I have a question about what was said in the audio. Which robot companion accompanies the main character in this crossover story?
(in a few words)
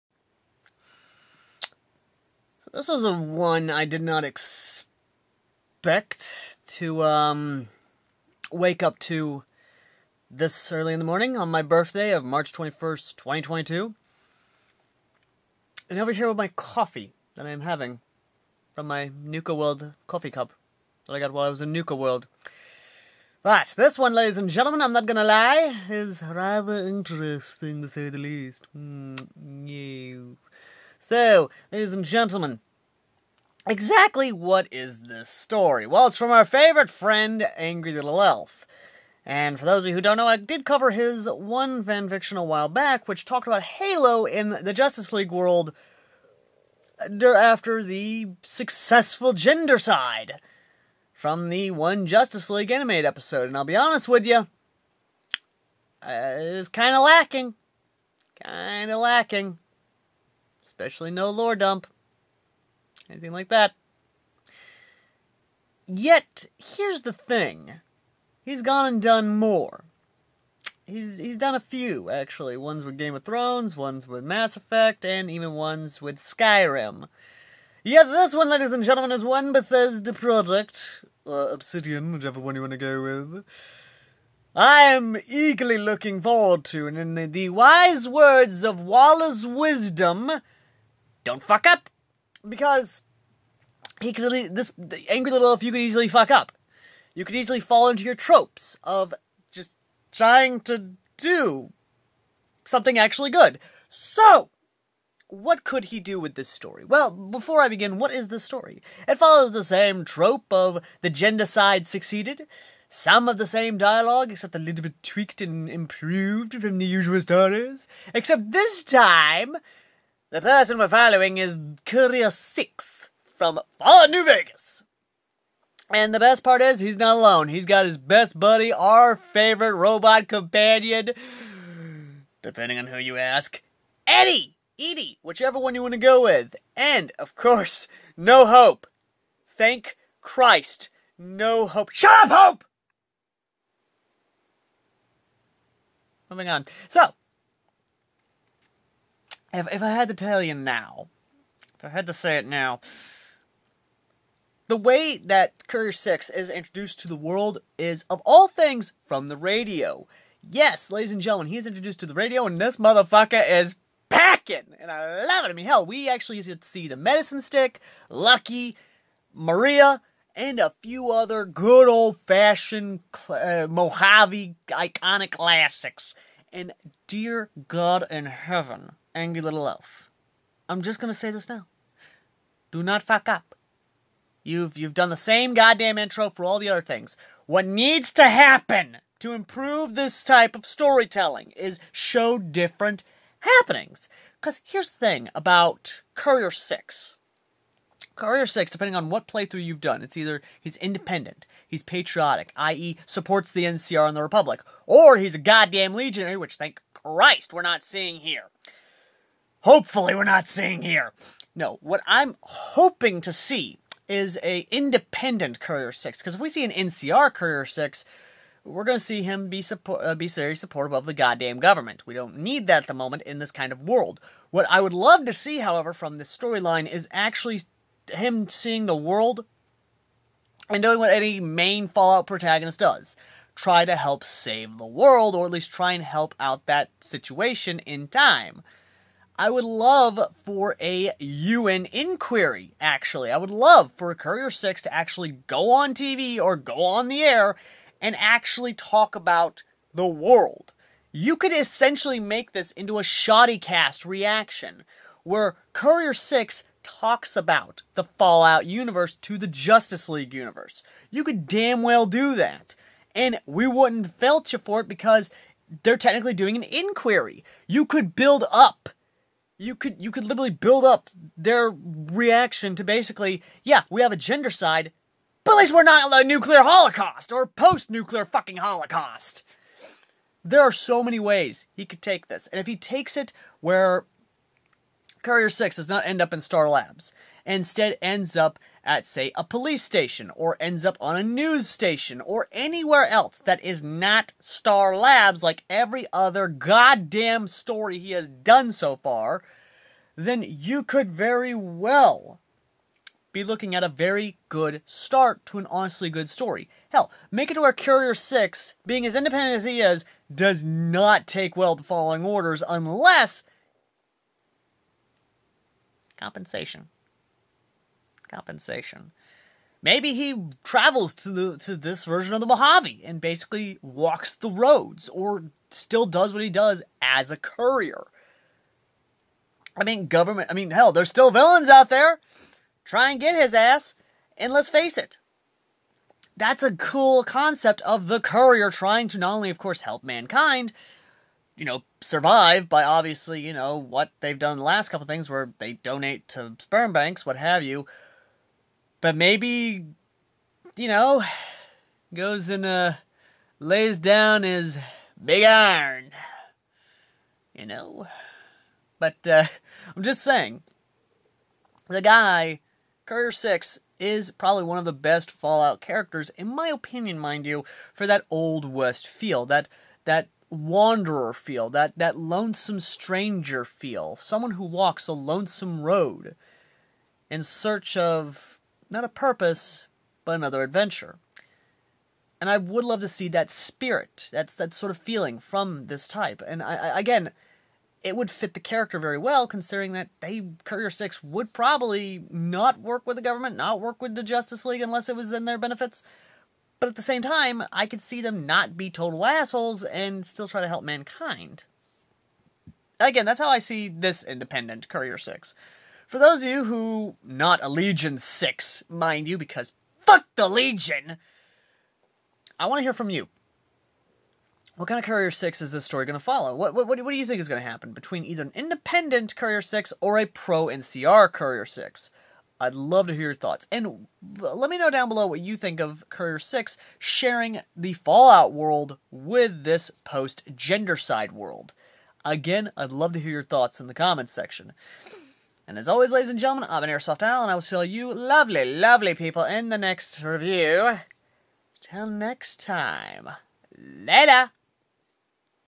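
Eddie.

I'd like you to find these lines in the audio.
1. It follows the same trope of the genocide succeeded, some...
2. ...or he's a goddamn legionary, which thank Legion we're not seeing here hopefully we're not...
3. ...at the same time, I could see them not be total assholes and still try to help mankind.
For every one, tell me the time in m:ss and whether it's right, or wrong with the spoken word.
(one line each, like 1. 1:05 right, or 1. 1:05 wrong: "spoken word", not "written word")
1. 1:49 right
2. 3:24 wrong: "Christ", not "Legion"
3. 6:36 right.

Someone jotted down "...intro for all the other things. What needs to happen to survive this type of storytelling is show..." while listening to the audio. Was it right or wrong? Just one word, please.
wrong.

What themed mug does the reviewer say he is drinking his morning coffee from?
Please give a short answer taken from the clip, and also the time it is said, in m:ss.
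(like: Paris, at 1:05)
Nuka World coffee cup, at 0:19.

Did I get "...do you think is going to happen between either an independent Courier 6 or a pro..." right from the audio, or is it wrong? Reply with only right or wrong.
right.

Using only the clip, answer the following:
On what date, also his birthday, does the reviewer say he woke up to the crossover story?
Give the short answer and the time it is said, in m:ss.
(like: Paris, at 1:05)
March 21st, 2022, at 0:12.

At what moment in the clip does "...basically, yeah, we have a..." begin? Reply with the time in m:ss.
4:32.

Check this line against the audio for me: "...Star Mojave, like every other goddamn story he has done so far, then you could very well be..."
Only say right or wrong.
wrong.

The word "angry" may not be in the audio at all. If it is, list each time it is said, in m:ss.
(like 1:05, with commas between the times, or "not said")
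0:37, 1:35, 2:59.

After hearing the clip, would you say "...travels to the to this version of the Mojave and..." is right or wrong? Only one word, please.
right.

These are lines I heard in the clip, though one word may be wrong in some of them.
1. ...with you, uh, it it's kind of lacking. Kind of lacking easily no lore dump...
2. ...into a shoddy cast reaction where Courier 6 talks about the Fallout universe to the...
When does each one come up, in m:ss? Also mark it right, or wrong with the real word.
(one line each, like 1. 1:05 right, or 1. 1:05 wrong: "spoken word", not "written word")
1. 0:54 wrong: "especially", not "easily"
2. 4:12 right.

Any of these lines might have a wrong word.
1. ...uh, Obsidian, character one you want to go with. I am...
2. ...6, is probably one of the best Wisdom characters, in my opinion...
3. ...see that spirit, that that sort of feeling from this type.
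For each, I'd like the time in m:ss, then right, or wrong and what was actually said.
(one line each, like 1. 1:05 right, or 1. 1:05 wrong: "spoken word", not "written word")
1. 1:21 wrong: "whichever", not "character"
2. 6:03 wrong: "Fallout", not "Wisdom"
3. 6:23 right.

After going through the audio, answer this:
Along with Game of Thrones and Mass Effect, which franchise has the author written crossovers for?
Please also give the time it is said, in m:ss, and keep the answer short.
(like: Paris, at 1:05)
Skyrim, at 1:16.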